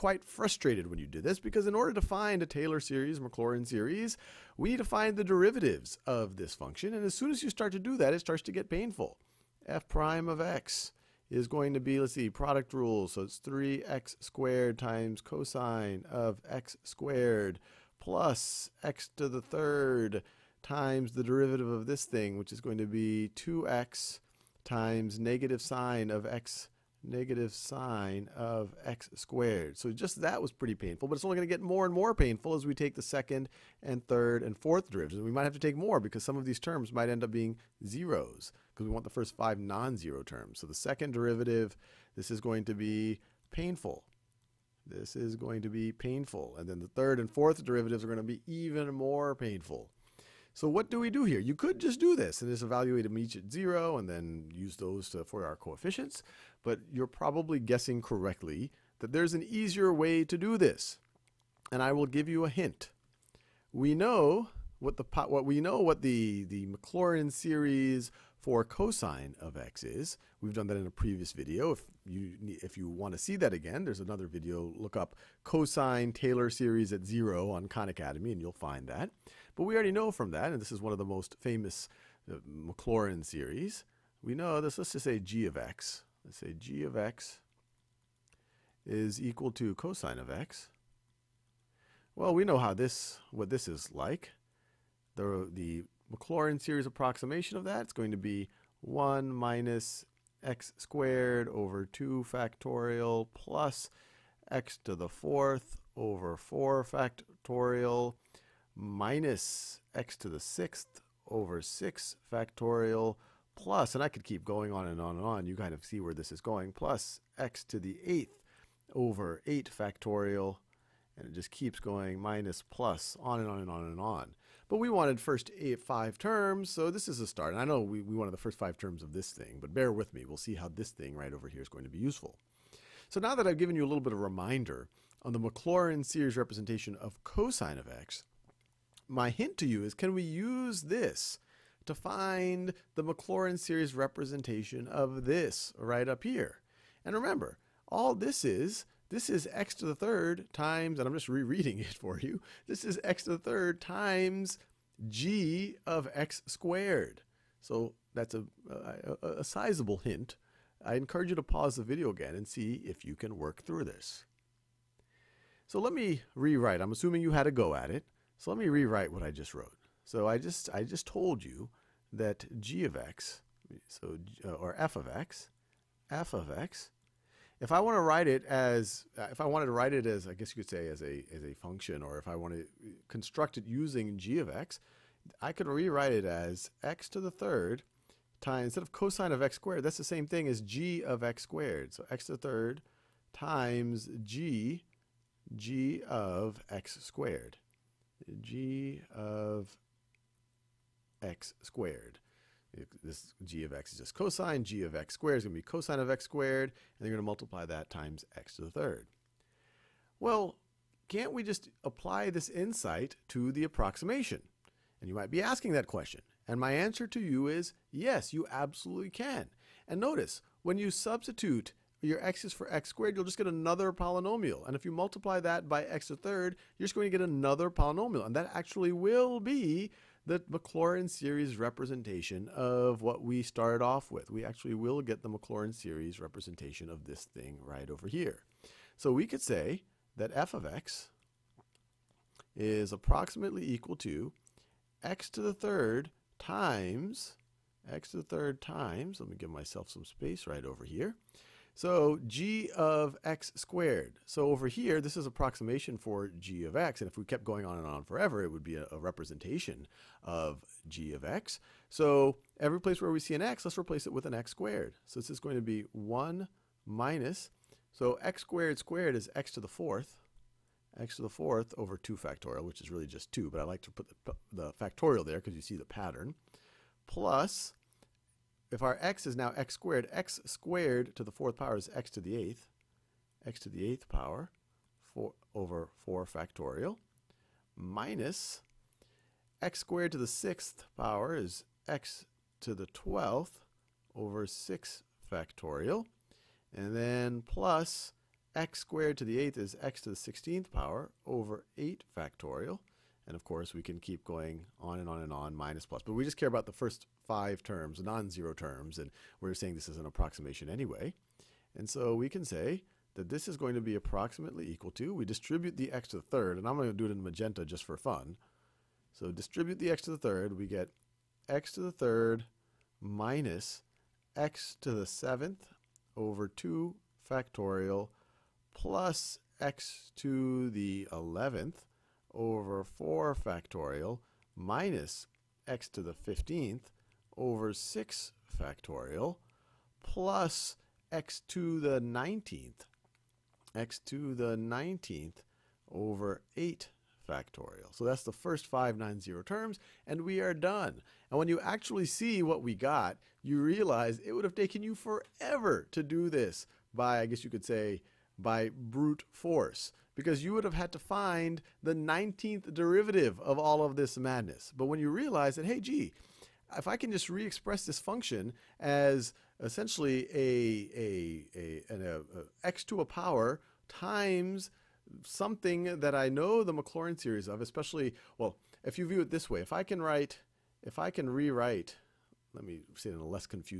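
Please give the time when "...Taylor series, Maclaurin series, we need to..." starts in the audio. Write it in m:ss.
0:02.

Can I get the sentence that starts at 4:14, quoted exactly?
So over here, this is approximation for g of x.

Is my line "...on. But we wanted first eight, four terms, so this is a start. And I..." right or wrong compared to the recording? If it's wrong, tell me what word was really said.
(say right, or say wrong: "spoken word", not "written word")
wrong: "five", not "four".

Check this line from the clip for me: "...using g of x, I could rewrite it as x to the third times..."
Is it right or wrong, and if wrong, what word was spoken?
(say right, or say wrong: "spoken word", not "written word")
right.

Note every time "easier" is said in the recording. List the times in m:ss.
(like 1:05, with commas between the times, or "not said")
0:59.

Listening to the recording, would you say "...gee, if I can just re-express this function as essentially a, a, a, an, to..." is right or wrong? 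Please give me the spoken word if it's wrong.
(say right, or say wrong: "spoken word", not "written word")
right.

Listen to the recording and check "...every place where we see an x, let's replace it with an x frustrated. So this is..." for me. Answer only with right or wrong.
wrong.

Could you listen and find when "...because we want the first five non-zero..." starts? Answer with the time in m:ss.
0:38.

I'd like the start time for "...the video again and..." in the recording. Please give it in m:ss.
2:41.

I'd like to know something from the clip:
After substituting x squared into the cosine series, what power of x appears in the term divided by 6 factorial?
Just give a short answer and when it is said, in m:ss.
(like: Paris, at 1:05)
x to the 12th, at 4:51.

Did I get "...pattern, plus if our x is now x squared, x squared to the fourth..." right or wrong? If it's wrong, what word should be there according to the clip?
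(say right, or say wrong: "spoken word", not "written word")
right.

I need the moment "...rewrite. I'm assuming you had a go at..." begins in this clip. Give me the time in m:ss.
2:46.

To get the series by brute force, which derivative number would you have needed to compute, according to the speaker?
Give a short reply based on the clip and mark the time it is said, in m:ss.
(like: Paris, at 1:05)
19th, at 6:01.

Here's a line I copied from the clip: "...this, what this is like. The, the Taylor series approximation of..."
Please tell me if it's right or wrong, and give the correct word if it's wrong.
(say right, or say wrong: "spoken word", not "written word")
wrong: "Maclaurin", not "Taylor".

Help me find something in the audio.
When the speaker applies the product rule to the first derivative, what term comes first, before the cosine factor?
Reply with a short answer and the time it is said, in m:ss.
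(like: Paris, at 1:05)
3x squared, at 0:13.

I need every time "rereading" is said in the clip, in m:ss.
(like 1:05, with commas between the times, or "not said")
2:31.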